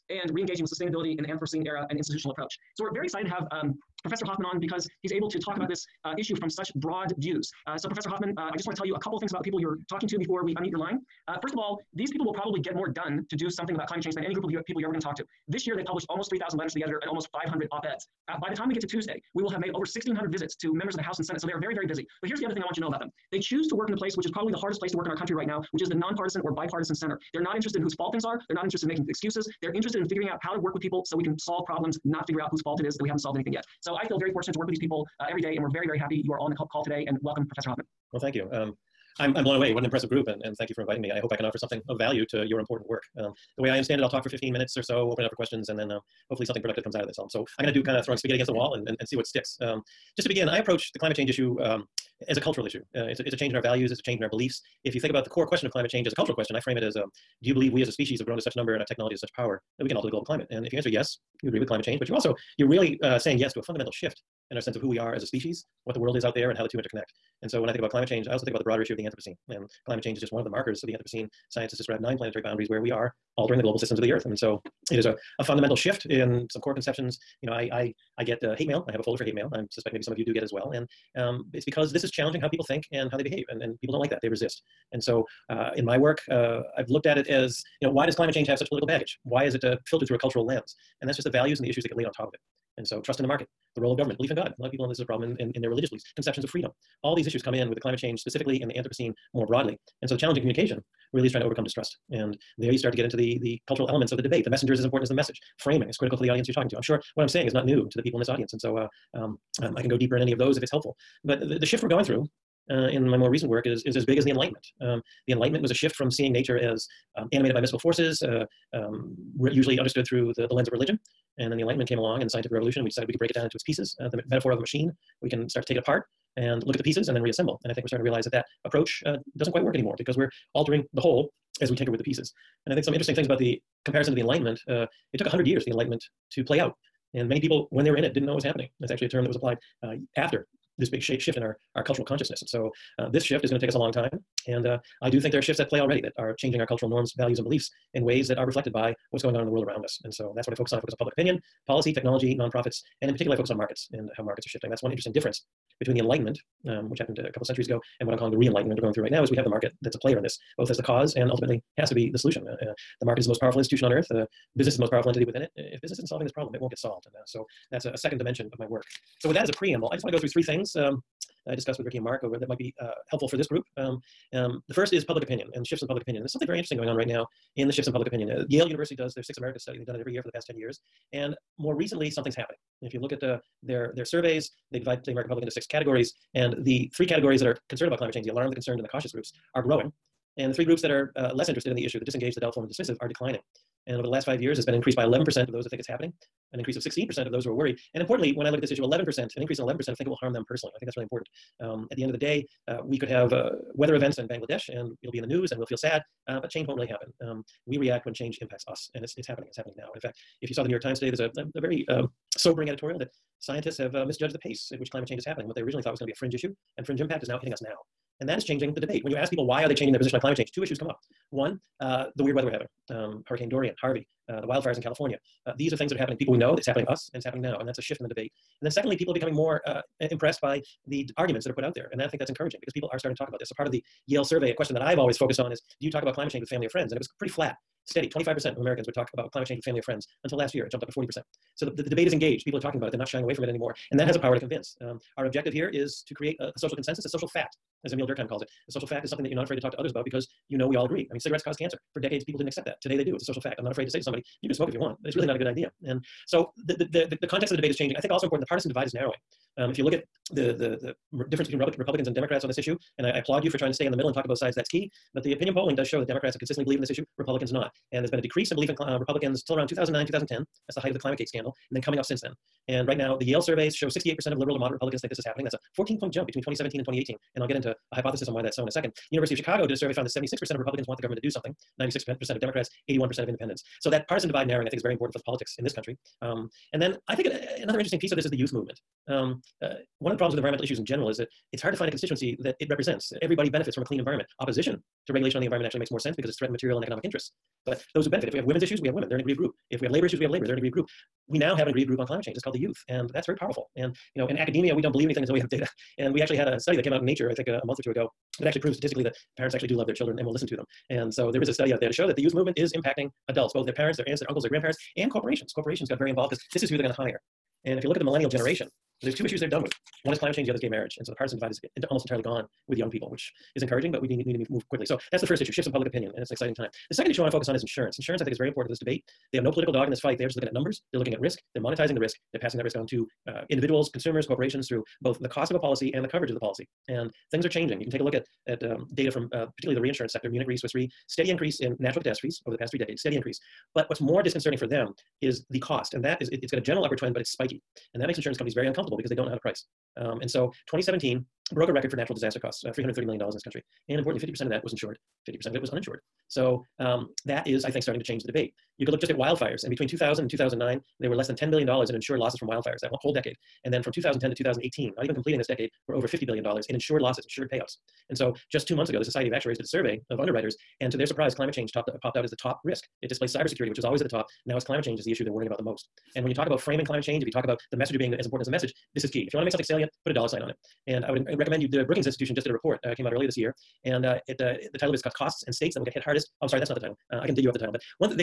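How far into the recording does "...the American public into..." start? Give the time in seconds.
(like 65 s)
185 s.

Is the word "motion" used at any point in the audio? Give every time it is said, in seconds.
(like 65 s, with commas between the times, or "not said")
not said.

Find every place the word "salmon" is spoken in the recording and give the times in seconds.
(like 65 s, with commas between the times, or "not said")
not said.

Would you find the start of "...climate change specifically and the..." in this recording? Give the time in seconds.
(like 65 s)
97 s.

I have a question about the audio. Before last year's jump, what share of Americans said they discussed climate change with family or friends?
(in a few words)
25%.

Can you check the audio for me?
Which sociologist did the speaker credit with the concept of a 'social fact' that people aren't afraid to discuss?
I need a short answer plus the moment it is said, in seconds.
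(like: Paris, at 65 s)
Emil Durkheim, at 247 s.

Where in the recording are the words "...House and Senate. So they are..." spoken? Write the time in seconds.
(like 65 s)
21 s.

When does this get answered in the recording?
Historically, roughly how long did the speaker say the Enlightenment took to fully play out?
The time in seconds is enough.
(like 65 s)
135 s.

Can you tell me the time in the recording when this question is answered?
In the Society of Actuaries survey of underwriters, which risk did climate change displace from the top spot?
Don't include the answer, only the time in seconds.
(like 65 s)
373 s.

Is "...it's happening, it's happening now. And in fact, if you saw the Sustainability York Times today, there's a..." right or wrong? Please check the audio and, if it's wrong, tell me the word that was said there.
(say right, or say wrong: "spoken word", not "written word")
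wrong: "New", not "Sustainability".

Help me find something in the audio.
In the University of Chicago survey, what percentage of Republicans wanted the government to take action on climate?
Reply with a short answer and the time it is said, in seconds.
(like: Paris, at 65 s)
76%, at 280 s.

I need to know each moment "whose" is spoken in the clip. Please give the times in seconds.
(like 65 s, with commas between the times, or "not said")
27 s, 32 s.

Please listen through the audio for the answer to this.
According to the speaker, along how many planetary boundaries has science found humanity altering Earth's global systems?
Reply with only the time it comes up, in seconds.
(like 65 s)
71 s.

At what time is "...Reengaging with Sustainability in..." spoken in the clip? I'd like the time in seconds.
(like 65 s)
0 s.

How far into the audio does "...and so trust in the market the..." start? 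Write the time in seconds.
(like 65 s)
92 s.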